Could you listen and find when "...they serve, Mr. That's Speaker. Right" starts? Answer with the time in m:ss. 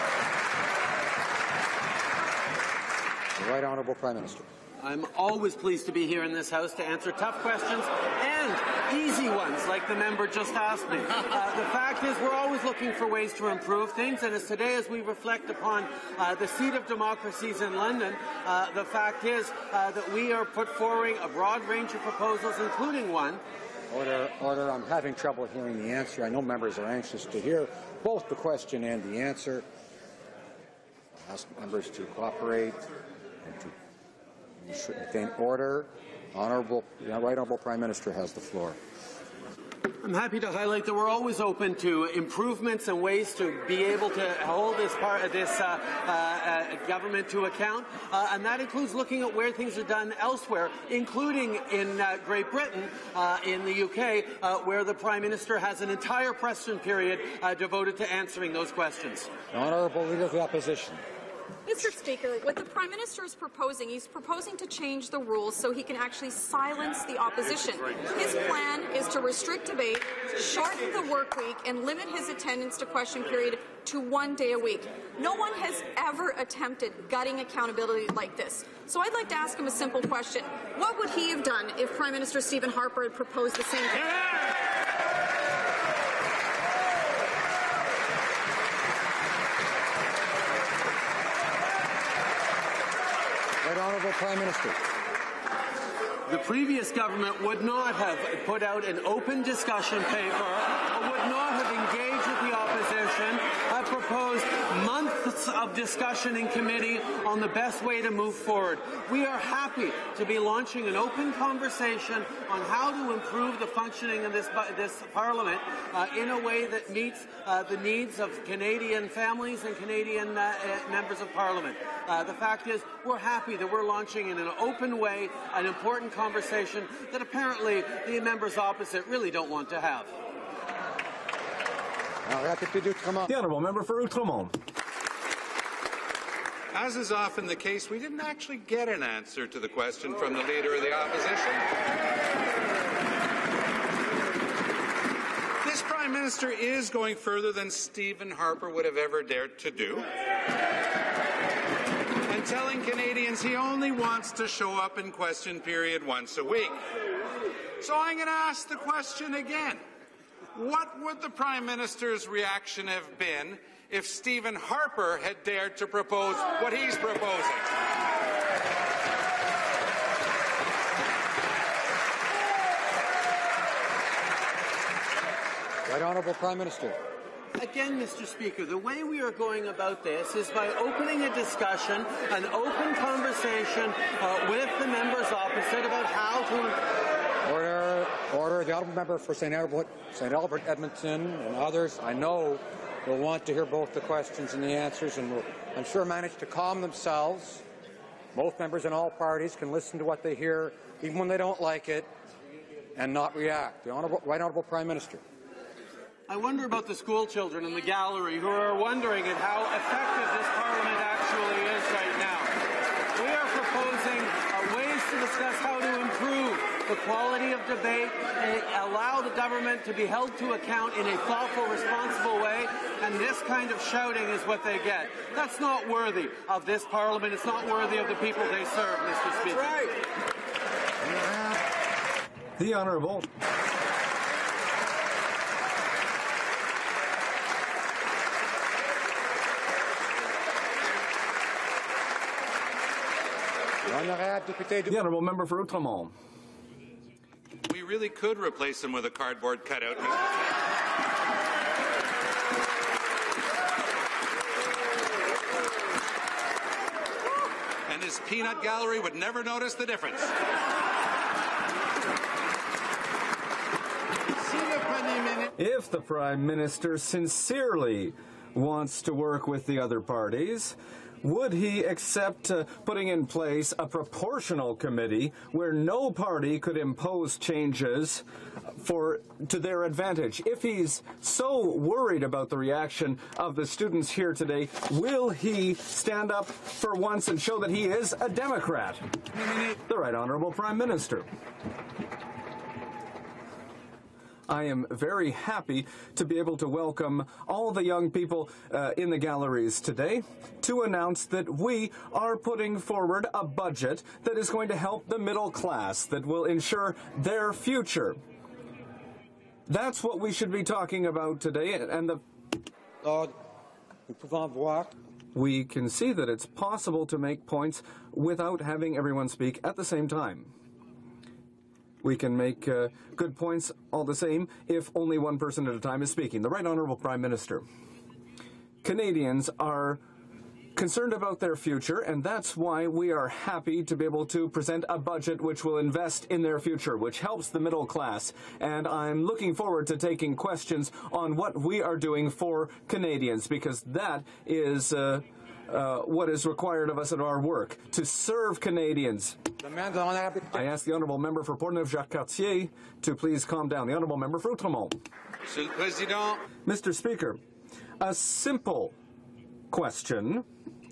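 3:48.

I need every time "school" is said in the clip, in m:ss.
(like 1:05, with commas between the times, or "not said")
3:26.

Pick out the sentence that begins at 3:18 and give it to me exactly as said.
Both members in all parties can listen to what they hear, even when they don't like it, and not react.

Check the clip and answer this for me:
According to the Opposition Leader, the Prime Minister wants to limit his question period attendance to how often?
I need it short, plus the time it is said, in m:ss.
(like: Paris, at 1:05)
one day a week, at 1:13.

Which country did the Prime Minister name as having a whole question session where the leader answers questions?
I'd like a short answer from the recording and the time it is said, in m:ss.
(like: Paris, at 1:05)
Great Britain, at 0:52.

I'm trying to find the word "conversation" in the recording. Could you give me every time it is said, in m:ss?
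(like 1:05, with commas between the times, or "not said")
1:51, 2:06, 3:02.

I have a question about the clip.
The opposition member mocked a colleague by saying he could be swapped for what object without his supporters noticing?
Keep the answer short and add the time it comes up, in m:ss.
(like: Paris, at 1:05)
a cardboard cutout, at 4:09.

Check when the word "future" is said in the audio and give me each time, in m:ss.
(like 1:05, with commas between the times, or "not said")
5:07, 5:31, 5:36.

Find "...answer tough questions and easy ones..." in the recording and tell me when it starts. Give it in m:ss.
0:06.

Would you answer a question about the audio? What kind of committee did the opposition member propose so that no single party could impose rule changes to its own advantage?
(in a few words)
proportional committee.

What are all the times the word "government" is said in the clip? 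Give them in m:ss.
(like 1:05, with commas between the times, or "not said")
0:46, 1:36, 3:39.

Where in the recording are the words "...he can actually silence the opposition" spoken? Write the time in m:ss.
1:05.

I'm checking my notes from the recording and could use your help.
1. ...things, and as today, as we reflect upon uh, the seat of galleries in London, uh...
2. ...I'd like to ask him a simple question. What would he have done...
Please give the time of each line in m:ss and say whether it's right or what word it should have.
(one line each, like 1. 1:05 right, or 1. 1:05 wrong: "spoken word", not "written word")
1. 0:13 wrong: "democracies", not "galleries"
2. 1:19 right.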